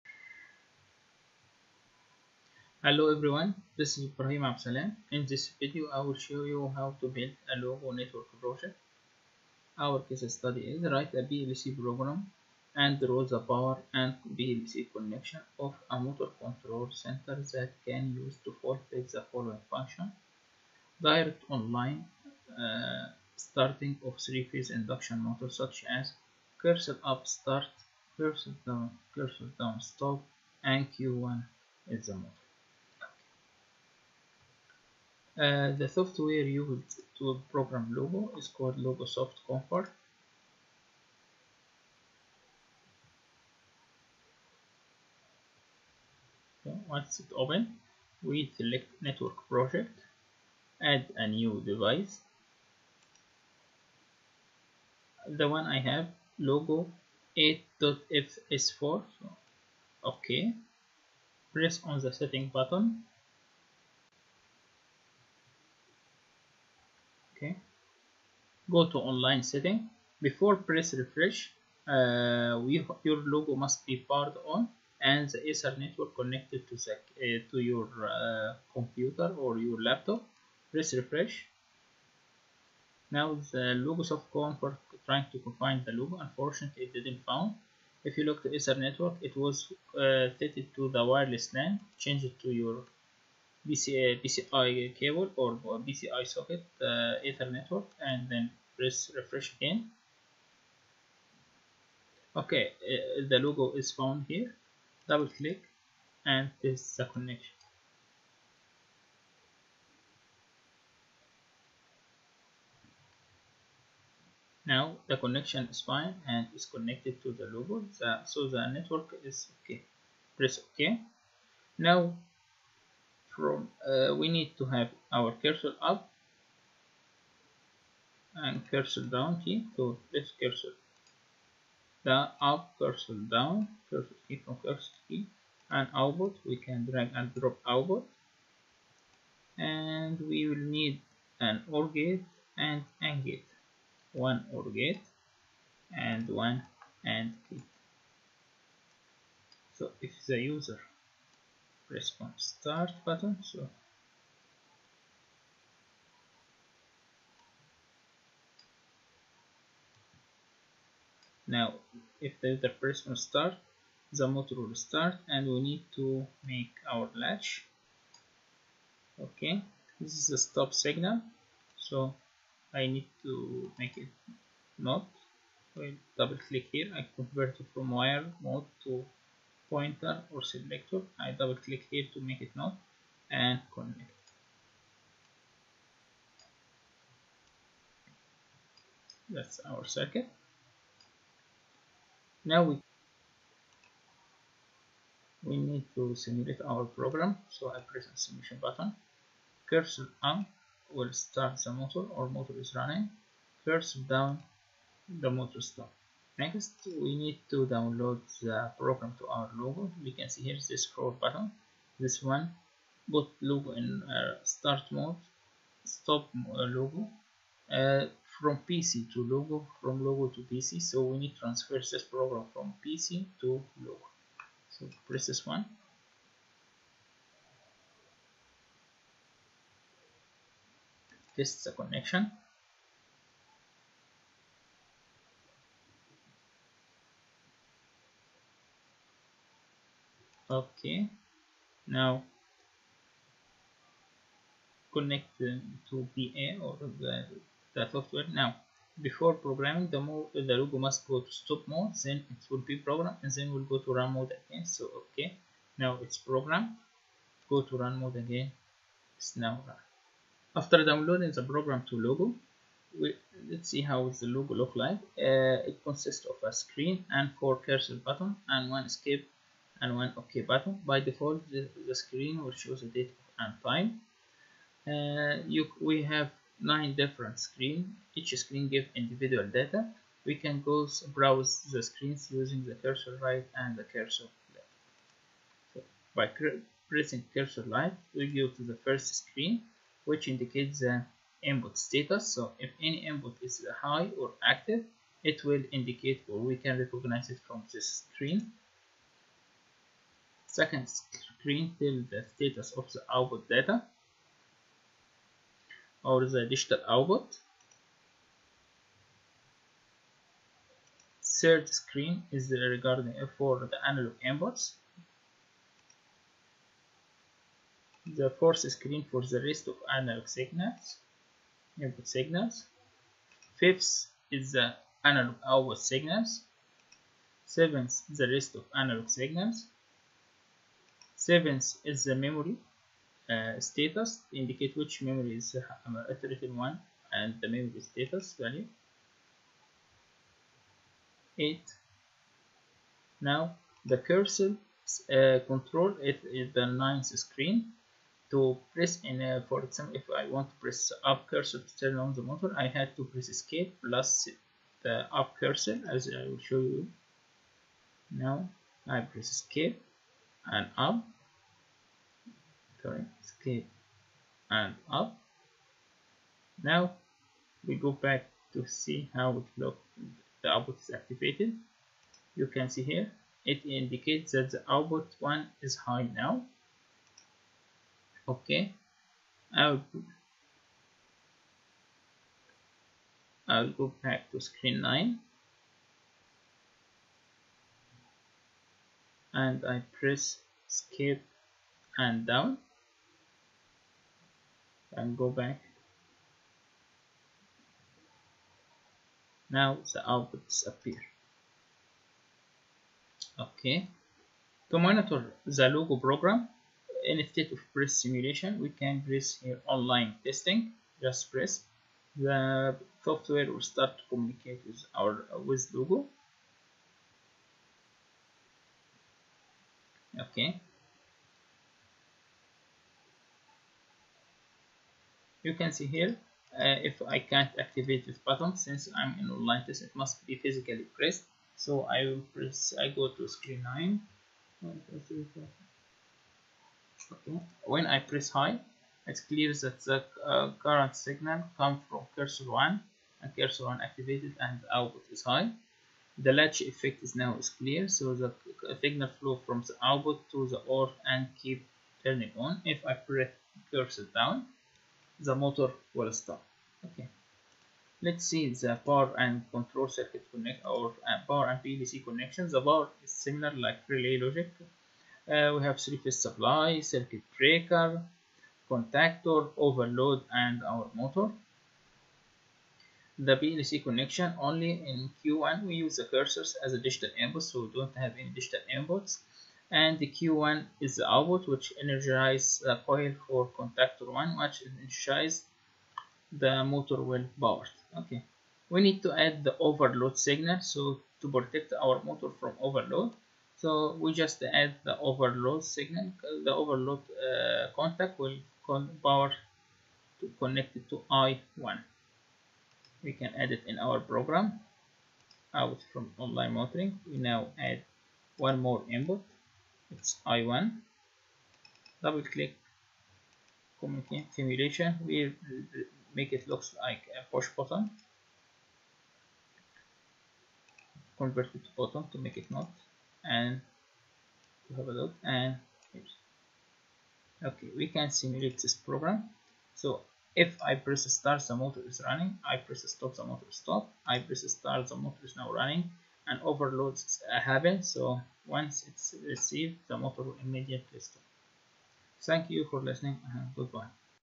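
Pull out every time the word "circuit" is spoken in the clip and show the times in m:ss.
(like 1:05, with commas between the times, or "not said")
3:09, 7:39, 7:46.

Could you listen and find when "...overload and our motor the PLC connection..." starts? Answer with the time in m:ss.
7:49.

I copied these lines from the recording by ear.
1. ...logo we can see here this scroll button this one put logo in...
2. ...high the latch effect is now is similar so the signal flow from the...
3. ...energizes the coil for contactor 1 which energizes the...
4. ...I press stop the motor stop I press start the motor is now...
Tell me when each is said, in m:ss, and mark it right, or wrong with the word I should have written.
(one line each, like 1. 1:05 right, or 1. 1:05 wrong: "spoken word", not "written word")
1. 3:29 right
2. 7:25 wrong: "clear", not "similar"
3. 8:01 right
4. 8:52 right.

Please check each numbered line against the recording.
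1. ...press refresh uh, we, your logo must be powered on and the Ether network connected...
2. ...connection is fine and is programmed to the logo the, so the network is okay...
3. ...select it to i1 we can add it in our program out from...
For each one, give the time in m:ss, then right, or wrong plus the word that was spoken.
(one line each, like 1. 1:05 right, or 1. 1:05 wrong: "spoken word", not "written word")
1. 1:10 right
2. 1:55 wrong: "connected", not "programmed"
3. 8:20 wrong: "connect", not "select".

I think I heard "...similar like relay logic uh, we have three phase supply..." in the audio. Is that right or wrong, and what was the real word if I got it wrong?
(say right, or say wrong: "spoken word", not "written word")
right.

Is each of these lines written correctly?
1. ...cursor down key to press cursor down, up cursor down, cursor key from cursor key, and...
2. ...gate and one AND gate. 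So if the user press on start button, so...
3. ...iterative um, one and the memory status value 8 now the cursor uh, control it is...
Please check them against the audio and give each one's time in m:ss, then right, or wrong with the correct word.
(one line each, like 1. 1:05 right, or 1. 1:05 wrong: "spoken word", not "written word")
1. 2:08 right
2. 2:24 right
3. 5:36 right.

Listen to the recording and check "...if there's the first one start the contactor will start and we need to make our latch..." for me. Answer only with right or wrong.
wrong.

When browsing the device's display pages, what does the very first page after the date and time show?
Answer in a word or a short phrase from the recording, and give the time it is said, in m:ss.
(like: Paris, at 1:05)
input status, at 4:51.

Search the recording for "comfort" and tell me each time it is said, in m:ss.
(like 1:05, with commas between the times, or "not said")
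0:39, 1:24.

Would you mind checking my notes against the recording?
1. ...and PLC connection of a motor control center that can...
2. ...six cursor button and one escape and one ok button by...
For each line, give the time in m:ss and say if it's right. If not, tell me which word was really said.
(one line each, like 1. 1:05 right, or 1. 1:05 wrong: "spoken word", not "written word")
1. 0:13 right
2. 4:27 wrong: "four", not "six".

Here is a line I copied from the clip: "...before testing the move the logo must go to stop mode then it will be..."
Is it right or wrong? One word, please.
wrong.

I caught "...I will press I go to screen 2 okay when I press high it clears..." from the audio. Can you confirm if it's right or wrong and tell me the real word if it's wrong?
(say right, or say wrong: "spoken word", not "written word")
wrong: "9", not "2".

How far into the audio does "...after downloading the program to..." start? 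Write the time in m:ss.
4:20.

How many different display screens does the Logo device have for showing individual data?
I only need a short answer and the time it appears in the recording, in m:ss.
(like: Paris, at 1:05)
9, at 4:36.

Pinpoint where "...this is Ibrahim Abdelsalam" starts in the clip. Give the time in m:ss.
0:03.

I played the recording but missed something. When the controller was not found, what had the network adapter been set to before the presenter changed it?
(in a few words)
wireless LAN.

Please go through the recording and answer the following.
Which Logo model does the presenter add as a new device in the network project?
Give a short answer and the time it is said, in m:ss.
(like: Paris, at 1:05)
Logo 8.fs4, at 0:56.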